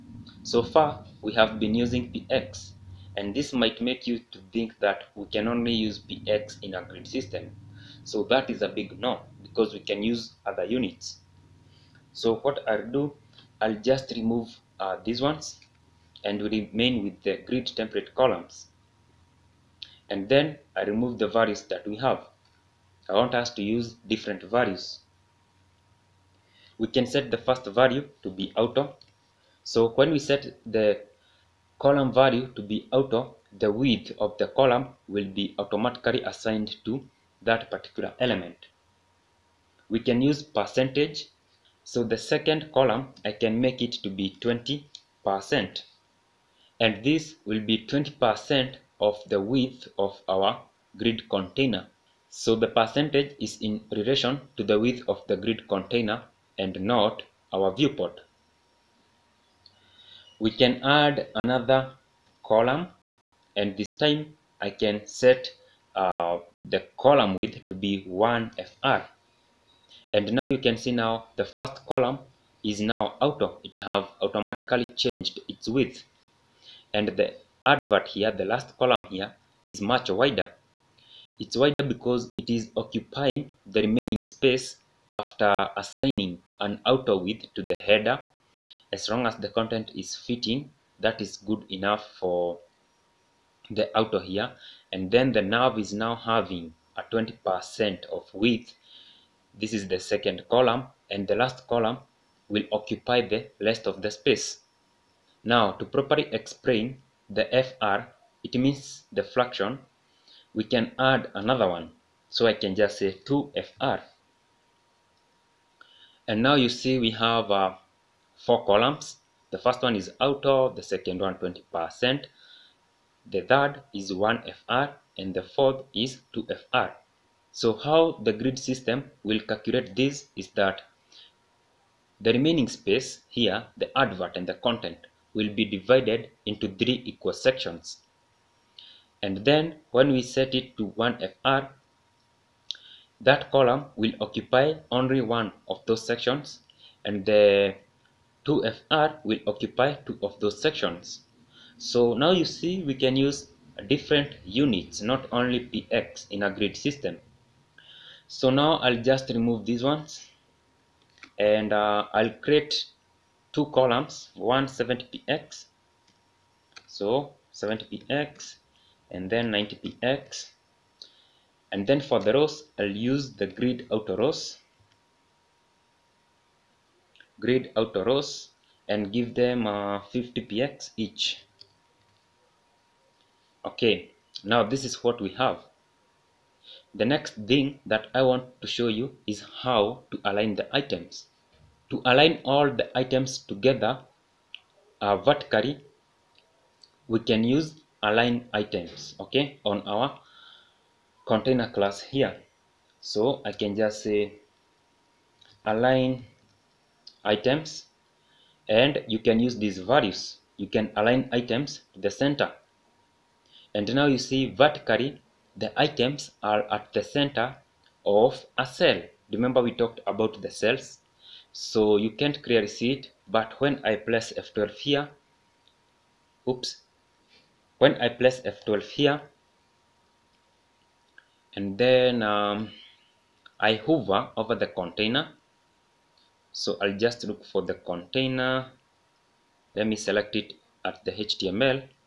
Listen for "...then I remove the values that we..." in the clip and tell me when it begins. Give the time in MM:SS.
00:20.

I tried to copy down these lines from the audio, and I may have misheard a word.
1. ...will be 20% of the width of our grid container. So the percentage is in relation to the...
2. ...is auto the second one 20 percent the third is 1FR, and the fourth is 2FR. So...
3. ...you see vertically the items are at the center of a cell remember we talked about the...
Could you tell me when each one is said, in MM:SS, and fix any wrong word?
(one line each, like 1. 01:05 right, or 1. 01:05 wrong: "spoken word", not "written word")
1. 00:47 right
2. 01:59 right
3. 03:34 right.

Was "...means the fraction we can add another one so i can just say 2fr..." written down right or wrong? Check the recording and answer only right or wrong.
right.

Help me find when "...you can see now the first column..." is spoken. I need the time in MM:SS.
01:10.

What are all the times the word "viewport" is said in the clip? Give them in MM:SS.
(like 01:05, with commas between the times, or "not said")
00:57.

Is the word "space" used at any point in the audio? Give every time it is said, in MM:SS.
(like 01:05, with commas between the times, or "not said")
01:24, 01:44, 02:12.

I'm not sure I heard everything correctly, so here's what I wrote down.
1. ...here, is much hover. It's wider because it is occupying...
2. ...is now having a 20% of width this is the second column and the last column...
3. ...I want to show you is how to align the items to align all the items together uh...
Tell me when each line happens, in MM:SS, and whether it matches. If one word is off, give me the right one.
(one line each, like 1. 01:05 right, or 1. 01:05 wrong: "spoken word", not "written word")
1. 01:19 wrong: "wider", not "hover"
2. 01:35 right
3. 03:08 right.